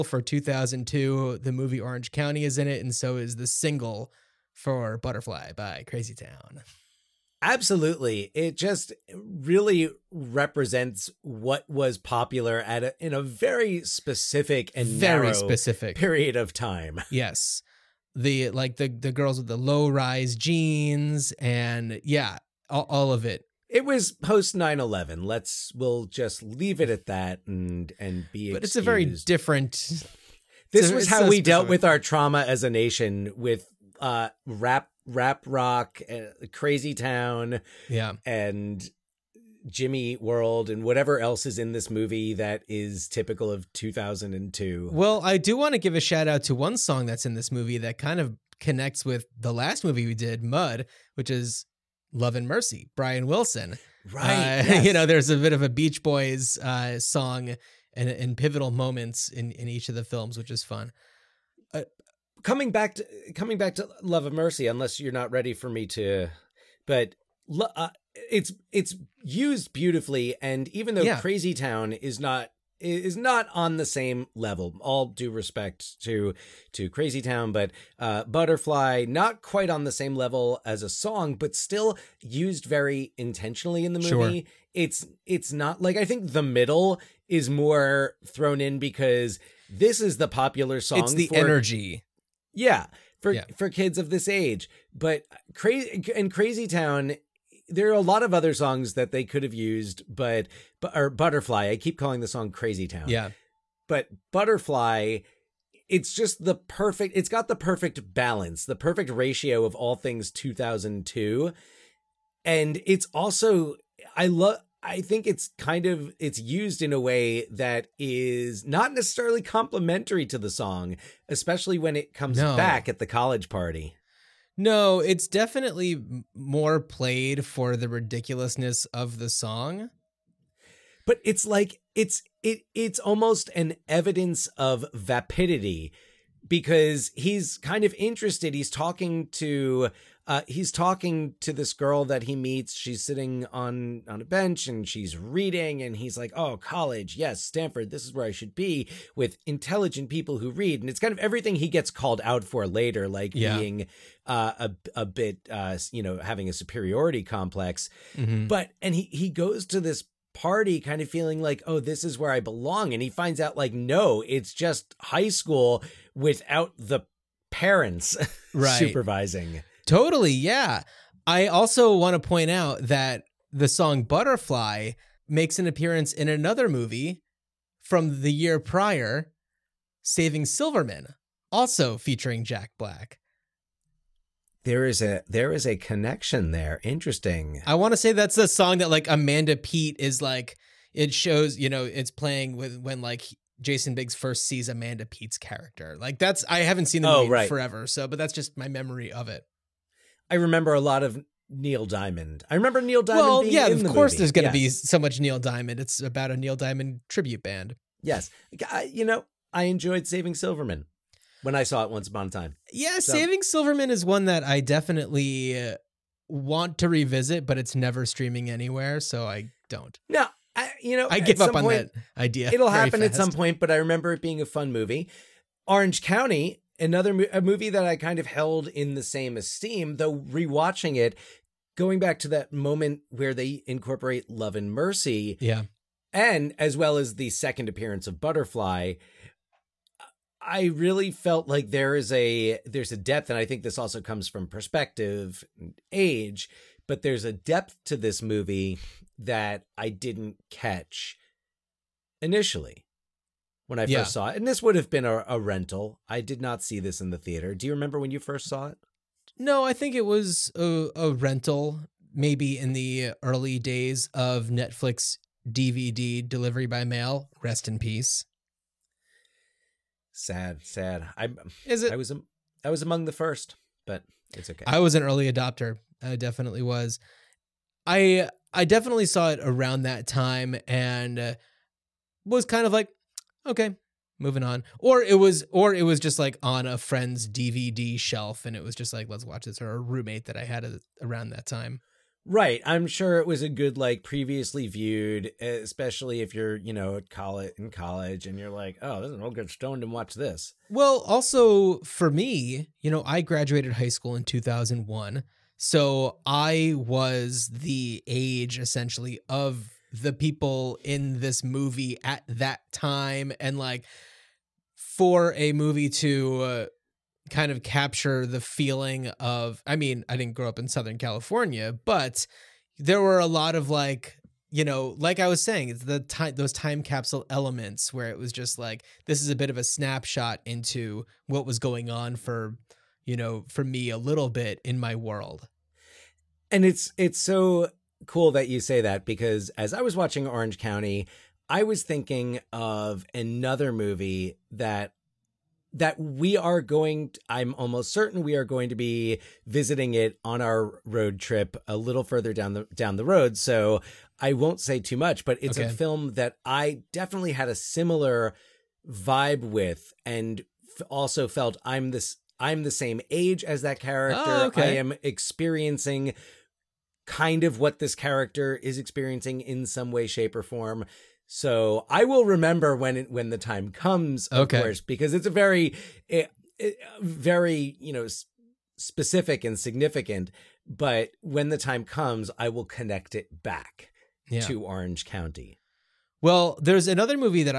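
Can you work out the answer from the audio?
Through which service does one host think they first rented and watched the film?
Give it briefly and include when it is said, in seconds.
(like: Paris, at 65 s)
Netflix, at 264 s.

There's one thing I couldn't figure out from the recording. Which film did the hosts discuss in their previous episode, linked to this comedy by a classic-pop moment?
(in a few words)
Mud.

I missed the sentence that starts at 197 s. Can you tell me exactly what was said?
forever, so but that's just my memory of it.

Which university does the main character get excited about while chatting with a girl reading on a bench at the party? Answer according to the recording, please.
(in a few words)
Stanford.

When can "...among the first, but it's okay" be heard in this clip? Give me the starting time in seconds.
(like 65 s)
272 s.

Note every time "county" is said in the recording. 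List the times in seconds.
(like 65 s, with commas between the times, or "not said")
2 s, 226 s, 340 s, 385 s.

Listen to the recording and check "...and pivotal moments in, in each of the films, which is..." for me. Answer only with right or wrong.
right.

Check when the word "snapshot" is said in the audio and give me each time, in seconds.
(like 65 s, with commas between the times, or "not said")
329 s.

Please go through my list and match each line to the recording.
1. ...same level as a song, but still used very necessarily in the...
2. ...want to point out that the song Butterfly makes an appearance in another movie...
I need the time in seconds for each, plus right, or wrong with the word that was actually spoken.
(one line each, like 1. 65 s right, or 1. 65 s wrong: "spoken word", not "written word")
1. 79 s wrong: "intentionally", not "necessarily"
2. 171 s right.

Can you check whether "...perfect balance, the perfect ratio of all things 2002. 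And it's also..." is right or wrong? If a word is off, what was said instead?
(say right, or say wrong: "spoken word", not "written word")
right.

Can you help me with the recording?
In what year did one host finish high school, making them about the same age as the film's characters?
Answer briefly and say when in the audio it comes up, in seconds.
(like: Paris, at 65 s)
2001, at 304 s.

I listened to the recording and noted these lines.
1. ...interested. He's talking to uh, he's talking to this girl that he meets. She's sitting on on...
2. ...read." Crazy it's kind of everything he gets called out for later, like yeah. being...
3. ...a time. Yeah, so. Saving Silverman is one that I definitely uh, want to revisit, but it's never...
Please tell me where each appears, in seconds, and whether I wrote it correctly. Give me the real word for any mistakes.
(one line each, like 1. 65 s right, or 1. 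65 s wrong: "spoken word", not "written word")
1. 137 s right
2. 150 s wrong: "And", not "Crazy"
3. 212 s right.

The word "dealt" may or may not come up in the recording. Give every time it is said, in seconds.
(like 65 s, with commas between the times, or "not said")
31 s.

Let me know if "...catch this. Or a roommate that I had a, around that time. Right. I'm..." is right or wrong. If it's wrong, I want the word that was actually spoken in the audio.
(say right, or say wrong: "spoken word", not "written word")
wrong: "watch", not "catch".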